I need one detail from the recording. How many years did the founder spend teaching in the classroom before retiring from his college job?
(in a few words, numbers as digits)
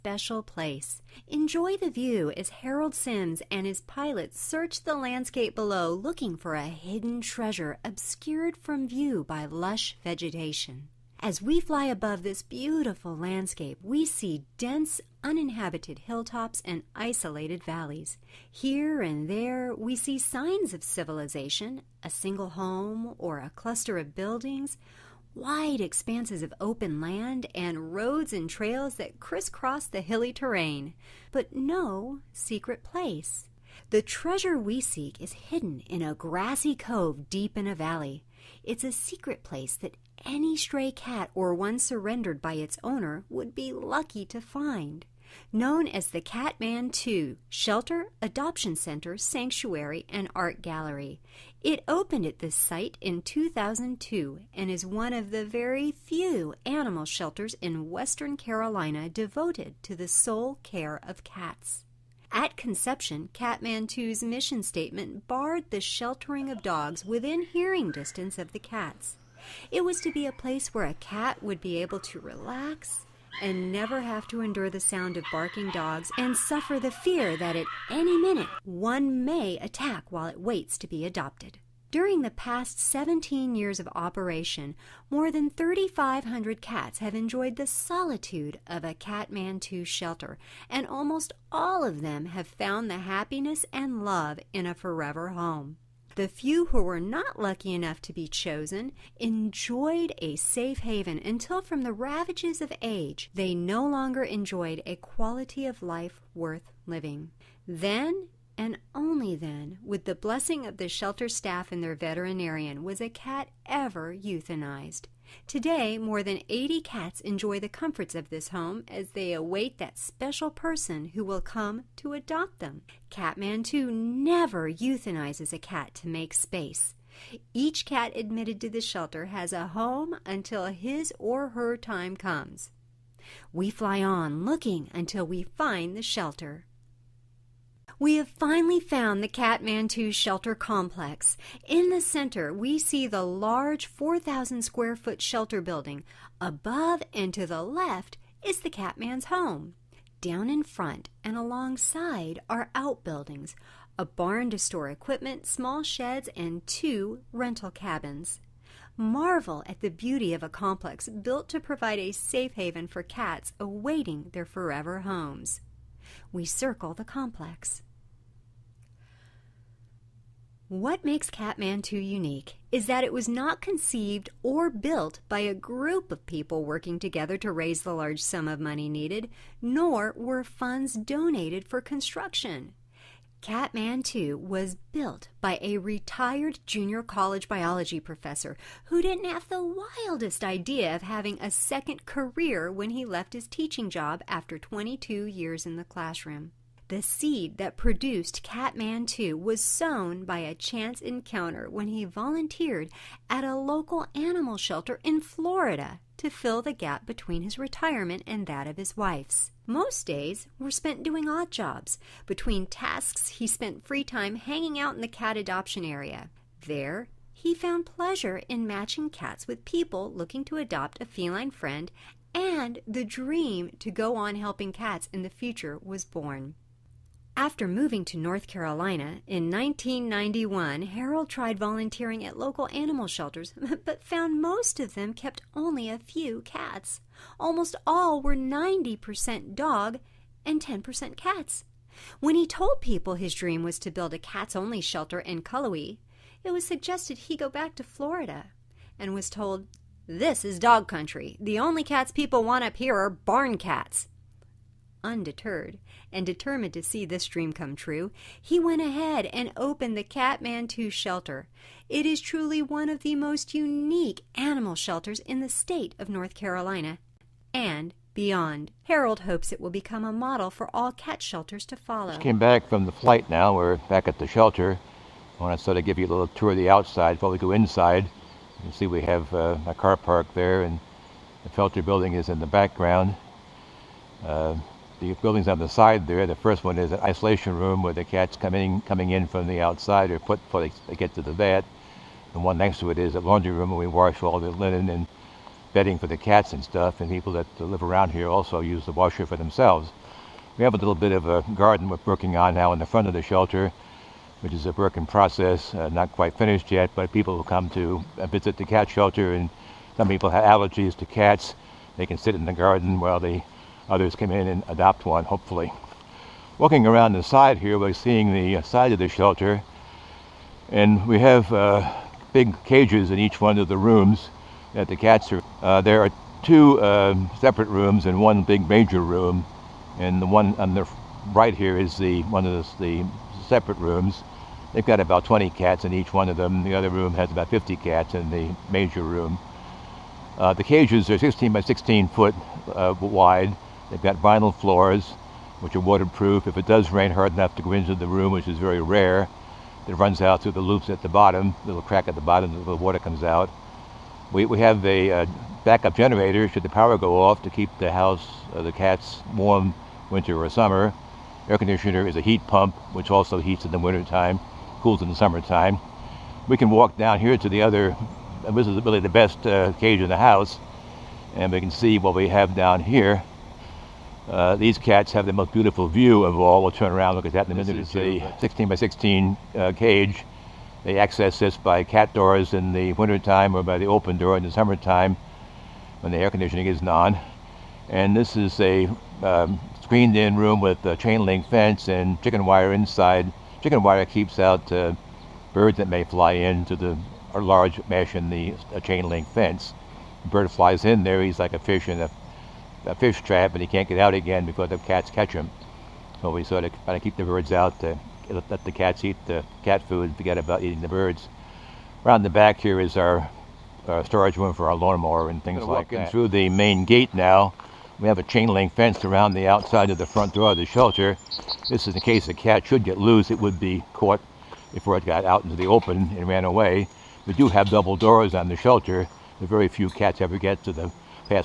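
22.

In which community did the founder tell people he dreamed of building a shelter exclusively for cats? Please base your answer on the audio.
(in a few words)
Cullowhee.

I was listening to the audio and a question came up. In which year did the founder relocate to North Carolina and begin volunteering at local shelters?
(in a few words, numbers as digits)
1991.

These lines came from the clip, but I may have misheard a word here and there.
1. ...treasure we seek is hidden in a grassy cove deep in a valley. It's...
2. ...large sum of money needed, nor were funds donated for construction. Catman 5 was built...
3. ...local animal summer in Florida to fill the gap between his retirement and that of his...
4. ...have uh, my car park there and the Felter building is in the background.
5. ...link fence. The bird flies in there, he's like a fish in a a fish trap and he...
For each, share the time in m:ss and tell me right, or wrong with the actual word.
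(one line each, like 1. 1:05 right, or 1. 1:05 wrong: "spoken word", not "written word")
1. 0:34 right
2. 2:57 wrong: "2", not "5"
3. 3:23 wrong: "shelter", not "summer"
4. 4:39 right
5. 6:39 right.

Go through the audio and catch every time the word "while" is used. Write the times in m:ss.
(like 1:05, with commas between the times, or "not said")
1:20, 5:12.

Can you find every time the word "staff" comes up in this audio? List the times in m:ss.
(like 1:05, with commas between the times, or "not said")
1:51.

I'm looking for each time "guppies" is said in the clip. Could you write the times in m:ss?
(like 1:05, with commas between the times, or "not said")
not said.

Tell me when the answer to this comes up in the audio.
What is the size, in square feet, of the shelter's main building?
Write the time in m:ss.
2:23.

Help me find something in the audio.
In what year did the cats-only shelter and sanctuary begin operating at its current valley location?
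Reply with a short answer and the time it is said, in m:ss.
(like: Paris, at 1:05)
2002, at 0:53.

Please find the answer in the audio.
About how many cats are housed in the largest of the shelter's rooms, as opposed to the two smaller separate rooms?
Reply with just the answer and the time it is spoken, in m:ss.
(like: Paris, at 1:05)
50, at 5:37.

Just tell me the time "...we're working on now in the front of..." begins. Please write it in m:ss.
5:01.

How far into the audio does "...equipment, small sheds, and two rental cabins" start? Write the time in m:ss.
2:34.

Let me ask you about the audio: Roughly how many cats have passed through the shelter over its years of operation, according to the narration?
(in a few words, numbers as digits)
3,500.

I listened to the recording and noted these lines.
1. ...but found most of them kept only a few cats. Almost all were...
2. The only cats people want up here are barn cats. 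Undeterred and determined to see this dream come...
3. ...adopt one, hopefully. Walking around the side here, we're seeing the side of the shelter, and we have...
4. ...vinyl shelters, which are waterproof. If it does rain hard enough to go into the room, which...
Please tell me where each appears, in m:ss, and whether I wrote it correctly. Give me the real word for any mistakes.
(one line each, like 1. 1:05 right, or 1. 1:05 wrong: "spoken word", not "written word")
1. 3:53 right
2. 4:11 right
3. 5:14 right
4. 5:44 wrong: "floors", not "shelters".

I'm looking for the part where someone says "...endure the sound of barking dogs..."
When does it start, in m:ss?
1:14.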